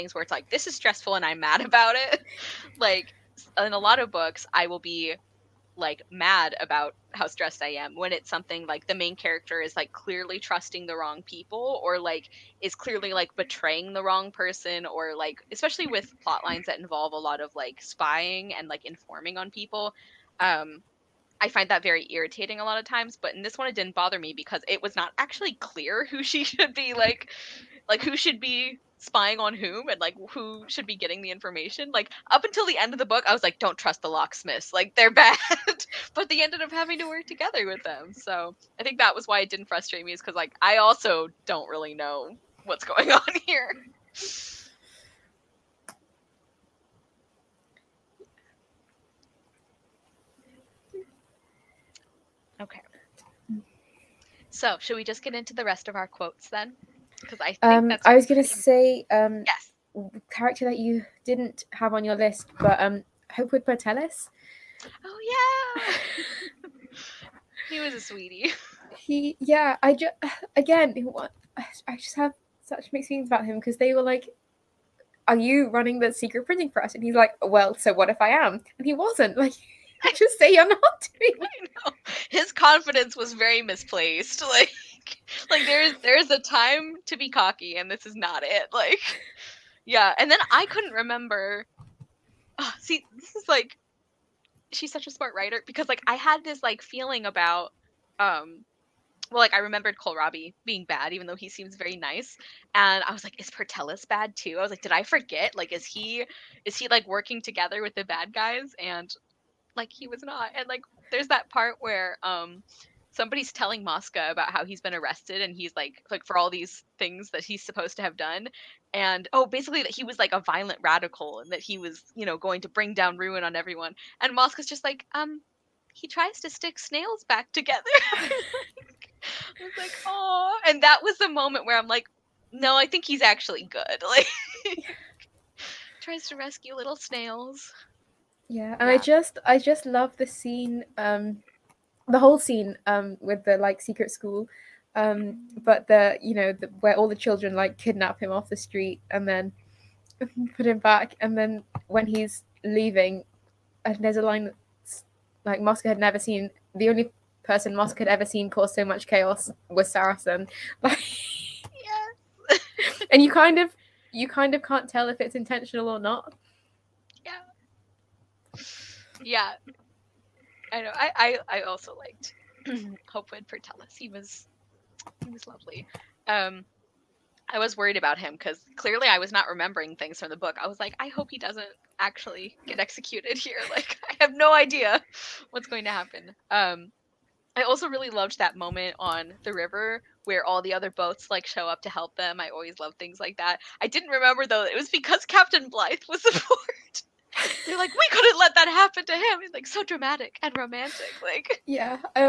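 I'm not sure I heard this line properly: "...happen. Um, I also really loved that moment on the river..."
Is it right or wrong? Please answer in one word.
right.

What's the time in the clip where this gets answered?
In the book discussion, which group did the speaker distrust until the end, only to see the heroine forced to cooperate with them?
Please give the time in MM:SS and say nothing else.
00:34.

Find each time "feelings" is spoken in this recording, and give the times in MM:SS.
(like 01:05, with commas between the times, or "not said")
01:13, 01:36.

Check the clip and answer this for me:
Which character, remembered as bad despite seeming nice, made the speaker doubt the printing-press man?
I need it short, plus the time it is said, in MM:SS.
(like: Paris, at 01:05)
Kohlrabi, at 01:39.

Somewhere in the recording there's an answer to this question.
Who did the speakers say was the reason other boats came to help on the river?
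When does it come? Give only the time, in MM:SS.
03:15.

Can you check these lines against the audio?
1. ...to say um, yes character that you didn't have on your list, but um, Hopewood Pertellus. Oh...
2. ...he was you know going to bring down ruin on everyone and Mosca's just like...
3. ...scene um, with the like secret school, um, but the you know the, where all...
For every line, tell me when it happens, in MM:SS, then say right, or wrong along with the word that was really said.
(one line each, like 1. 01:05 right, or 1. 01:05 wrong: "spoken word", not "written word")
1. 00:58 right
2. 02:01 right
3. 02:22 right.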